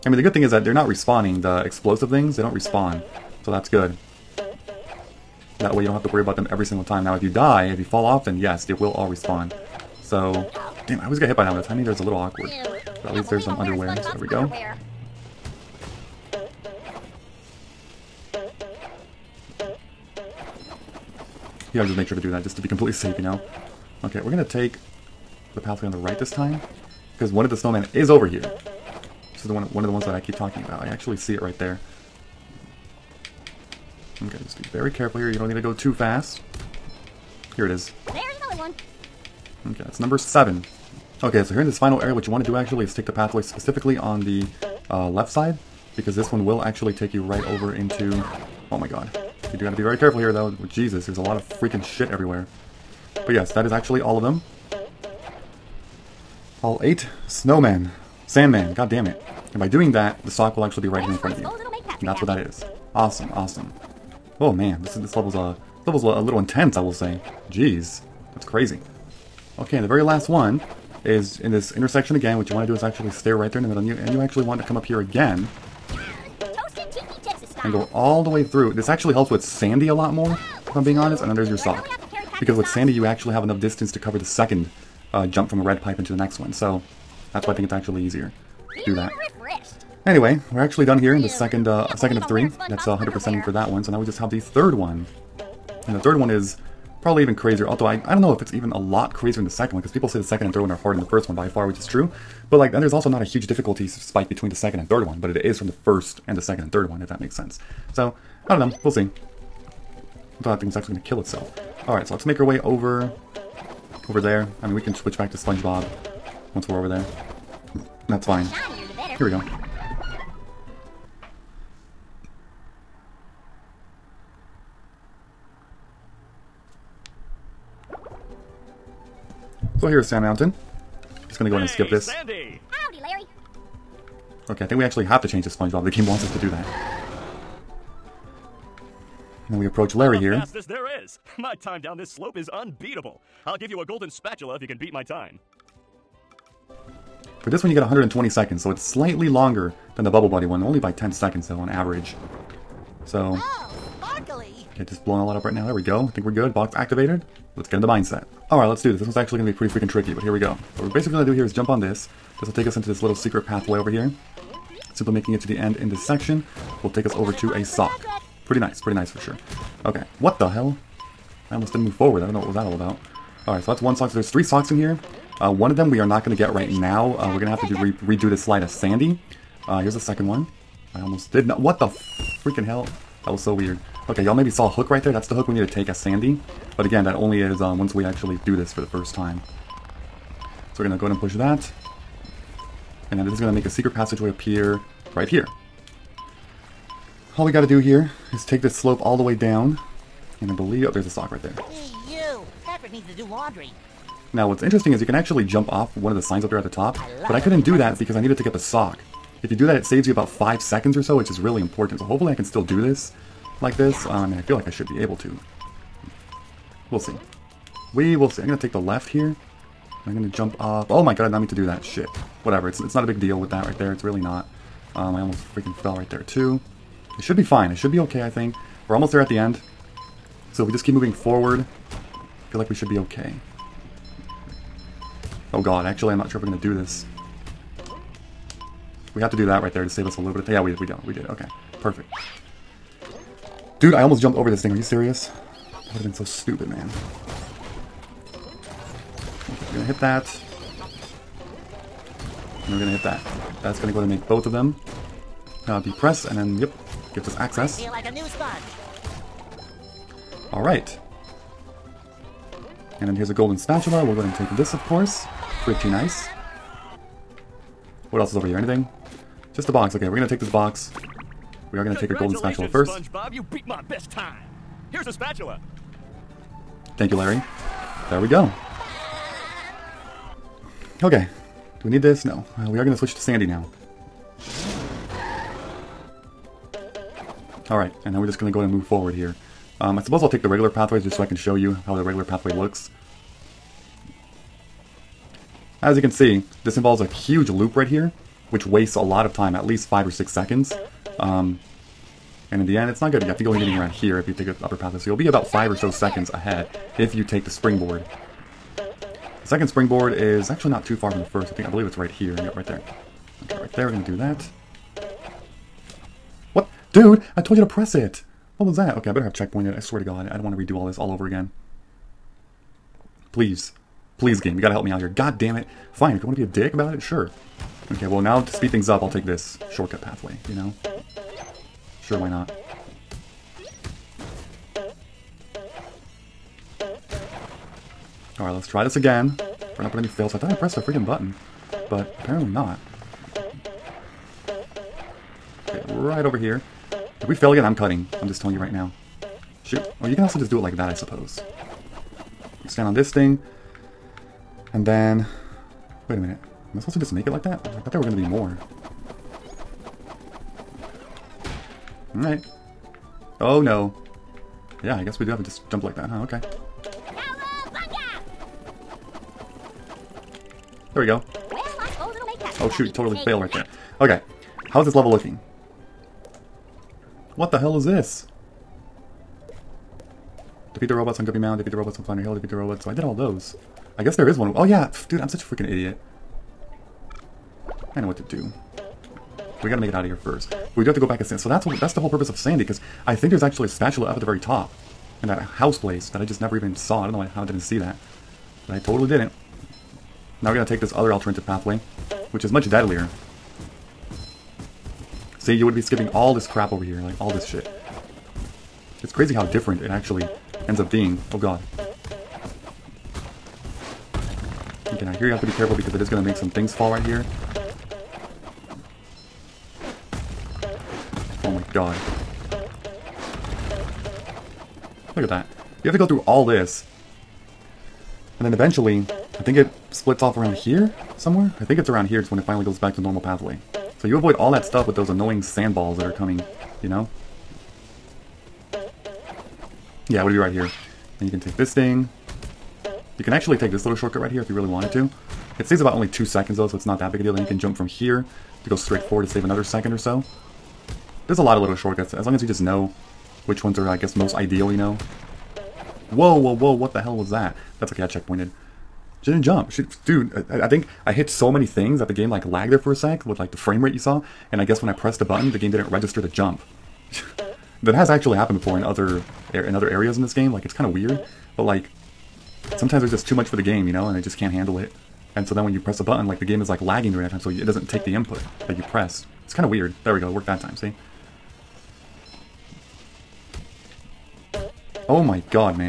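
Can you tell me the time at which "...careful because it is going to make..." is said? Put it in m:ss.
6:55.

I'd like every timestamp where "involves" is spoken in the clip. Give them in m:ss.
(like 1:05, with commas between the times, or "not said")
4:56.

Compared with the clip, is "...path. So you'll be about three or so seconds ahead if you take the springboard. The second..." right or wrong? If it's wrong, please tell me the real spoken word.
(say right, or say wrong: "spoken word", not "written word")
wrong: "five", not "three".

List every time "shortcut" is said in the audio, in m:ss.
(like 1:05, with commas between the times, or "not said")
5:29, 7:23, 7:31.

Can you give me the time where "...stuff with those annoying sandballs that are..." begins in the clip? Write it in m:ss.
7:14.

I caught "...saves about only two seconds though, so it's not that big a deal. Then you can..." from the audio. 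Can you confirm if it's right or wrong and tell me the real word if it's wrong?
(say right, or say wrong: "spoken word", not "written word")
right.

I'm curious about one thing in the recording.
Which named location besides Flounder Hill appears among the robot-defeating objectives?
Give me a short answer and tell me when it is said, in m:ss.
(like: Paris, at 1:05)
Guppy Mound, at 6:21.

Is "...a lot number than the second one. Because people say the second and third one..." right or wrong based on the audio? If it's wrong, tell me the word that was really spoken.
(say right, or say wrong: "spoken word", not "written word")
wrong: "crazier", not "number".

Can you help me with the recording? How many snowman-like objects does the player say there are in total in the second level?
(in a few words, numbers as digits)
8.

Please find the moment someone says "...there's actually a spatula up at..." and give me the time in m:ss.
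6:33.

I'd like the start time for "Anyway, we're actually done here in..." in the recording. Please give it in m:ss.
1:30.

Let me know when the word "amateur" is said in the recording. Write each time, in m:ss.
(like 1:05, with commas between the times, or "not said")
not said.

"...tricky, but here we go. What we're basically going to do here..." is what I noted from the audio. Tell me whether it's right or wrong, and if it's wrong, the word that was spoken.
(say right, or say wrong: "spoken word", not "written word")
right.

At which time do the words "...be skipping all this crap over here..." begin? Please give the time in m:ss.
6:45.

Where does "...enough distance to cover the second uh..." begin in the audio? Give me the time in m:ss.
1:23.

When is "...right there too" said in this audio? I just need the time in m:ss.
3:45.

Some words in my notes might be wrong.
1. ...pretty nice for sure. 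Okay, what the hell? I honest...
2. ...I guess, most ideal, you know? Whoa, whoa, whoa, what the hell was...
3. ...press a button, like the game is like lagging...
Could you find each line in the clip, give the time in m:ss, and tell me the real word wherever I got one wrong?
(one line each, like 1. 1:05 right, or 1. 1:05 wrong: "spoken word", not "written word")
1. 2:48 wrong: "almost", not "honest"
2. 7:33 right
3. 7:55 right.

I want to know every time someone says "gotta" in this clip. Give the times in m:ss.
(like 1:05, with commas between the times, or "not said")
5:24, 6:29.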